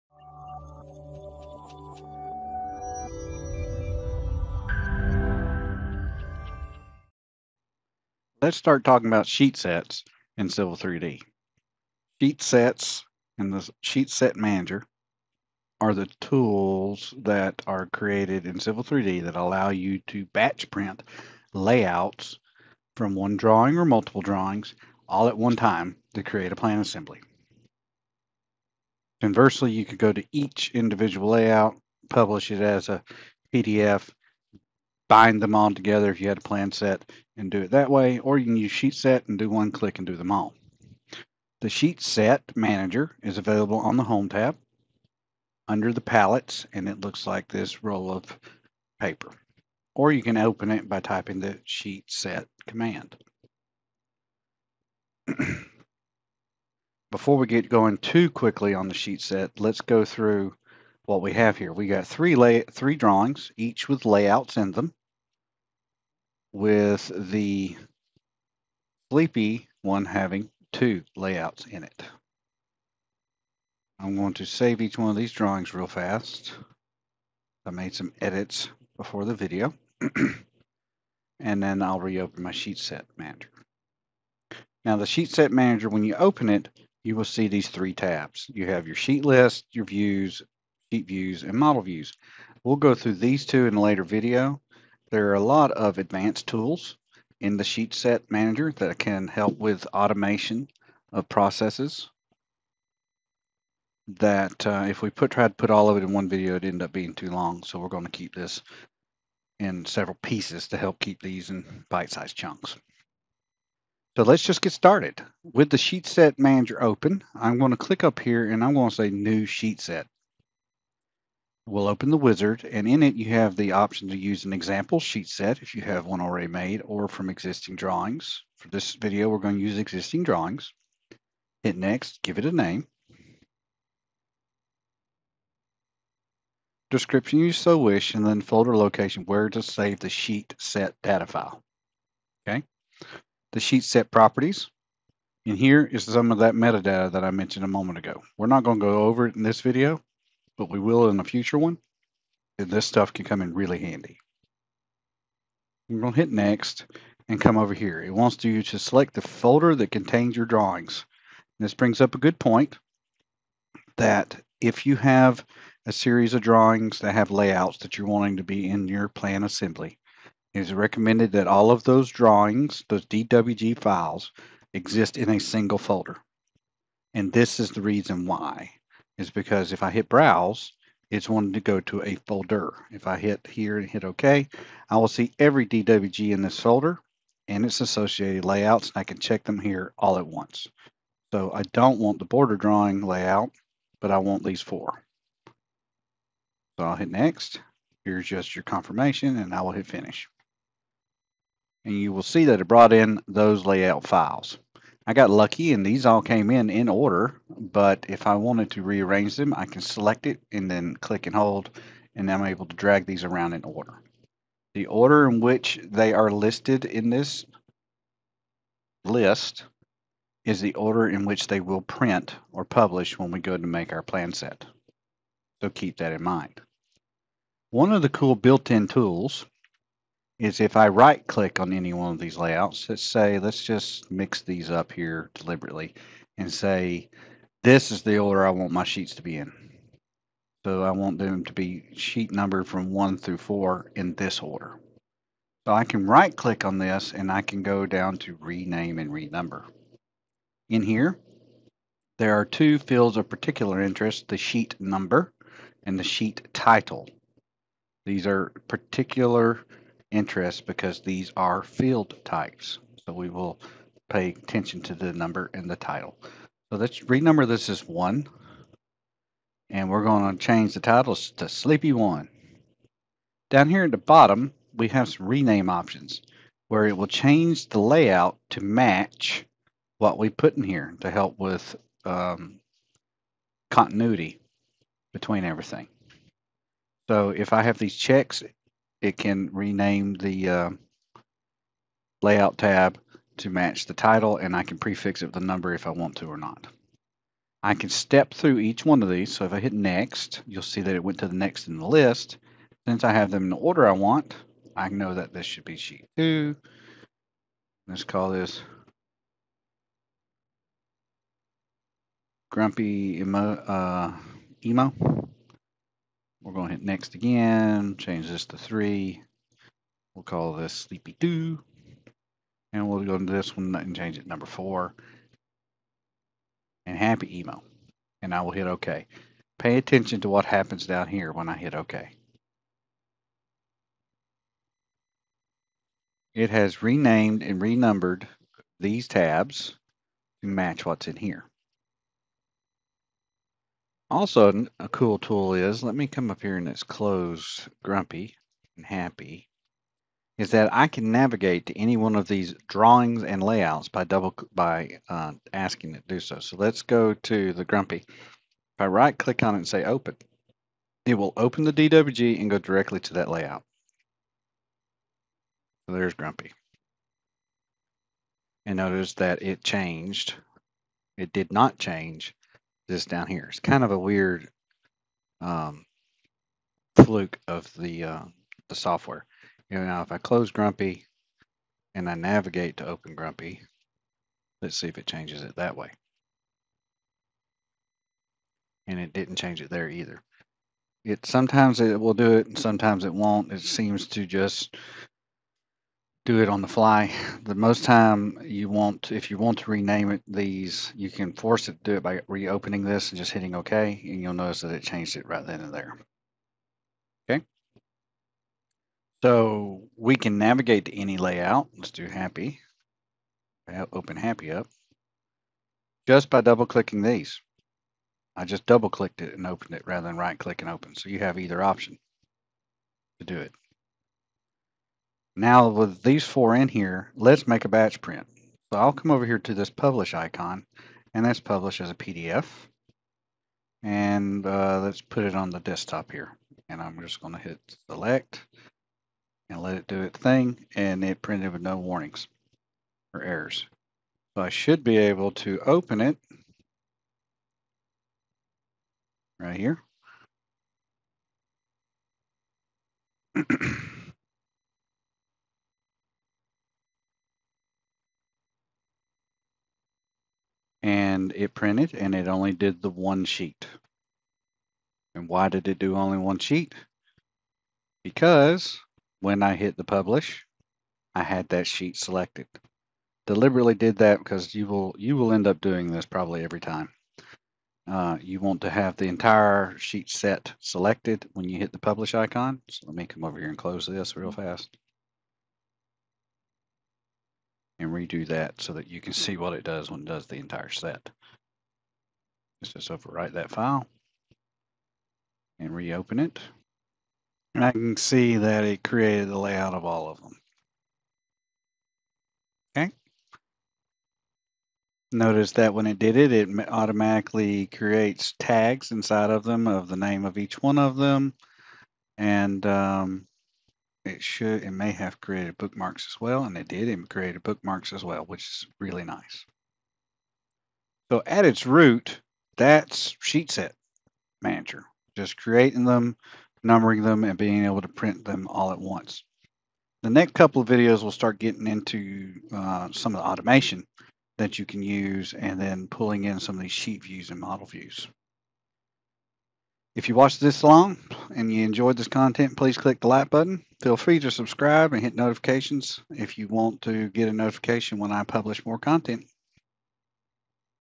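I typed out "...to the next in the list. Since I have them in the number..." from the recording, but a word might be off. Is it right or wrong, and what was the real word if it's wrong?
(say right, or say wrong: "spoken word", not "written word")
wrong: "order", not "number".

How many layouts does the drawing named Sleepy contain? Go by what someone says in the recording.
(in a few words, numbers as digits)
2.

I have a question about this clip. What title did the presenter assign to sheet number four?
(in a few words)
Happy Emo.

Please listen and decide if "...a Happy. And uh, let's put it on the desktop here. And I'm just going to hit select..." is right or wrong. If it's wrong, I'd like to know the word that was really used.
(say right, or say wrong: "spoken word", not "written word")
wrong: "PDF", not "Happy".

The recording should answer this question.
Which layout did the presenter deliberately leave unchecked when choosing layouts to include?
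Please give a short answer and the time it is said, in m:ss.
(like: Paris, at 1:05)
Border drawing layout, at 3:12.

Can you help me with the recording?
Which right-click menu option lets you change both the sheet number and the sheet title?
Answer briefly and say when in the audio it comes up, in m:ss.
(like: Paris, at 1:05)
Rename and renumber, at 4:08.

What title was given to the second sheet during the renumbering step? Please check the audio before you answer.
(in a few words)
Grumpy Emo.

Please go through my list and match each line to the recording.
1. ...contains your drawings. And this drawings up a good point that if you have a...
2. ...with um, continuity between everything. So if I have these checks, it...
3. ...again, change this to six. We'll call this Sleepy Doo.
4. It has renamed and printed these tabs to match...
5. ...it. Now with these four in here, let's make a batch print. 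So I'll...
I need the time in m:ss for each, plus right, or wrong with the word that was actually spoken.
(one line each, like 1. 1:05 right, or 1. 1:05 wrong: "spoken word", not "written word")
1. 2:39 wrong: "brings", not "drawings"
2. 4:41 right
3. 5:17 wrong: "three", not "six"
4. 5:36 wrong: "renumbered", not "printed"
5. 7:03 right.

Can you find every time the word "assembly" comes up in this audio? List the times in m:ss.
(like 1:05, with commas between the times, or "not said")
0:26, 2:49.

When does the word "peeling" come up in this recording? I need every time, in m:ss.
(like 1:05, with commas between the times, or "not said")
not said.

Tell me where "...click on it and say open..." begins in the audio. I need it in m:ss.
5:59.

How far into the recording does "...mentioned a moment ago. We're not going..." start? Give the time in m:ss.
2:27.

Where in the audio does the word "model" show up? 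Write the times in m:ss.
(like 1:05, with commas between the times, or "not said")
1:31, 8:57.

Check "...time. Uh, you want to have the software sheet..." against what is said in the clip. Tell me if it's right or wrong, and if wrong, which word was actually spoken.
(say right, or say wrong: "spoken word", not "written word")
wrong: "entire", not "software".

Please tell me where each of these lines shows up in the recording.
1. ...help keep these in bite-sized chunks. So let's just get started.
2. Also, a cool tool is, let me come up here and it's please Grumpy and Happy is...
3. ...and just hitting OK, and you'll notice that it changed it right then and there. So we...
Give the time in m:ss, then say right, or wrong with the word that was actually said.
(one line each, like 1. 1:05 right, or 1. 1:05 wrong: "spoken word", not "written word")
1. 1:50 right
2. 5:44 wrong: "close", not "please"
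3. 6:43 right.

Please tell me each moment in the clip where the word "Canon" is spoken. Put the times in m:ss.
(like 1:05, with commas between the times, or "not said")
not said.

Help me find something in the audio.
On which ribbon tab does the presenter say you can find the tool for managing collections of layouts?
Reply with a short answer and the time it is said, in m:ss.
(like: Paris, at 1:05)
Home tab, at 0:44.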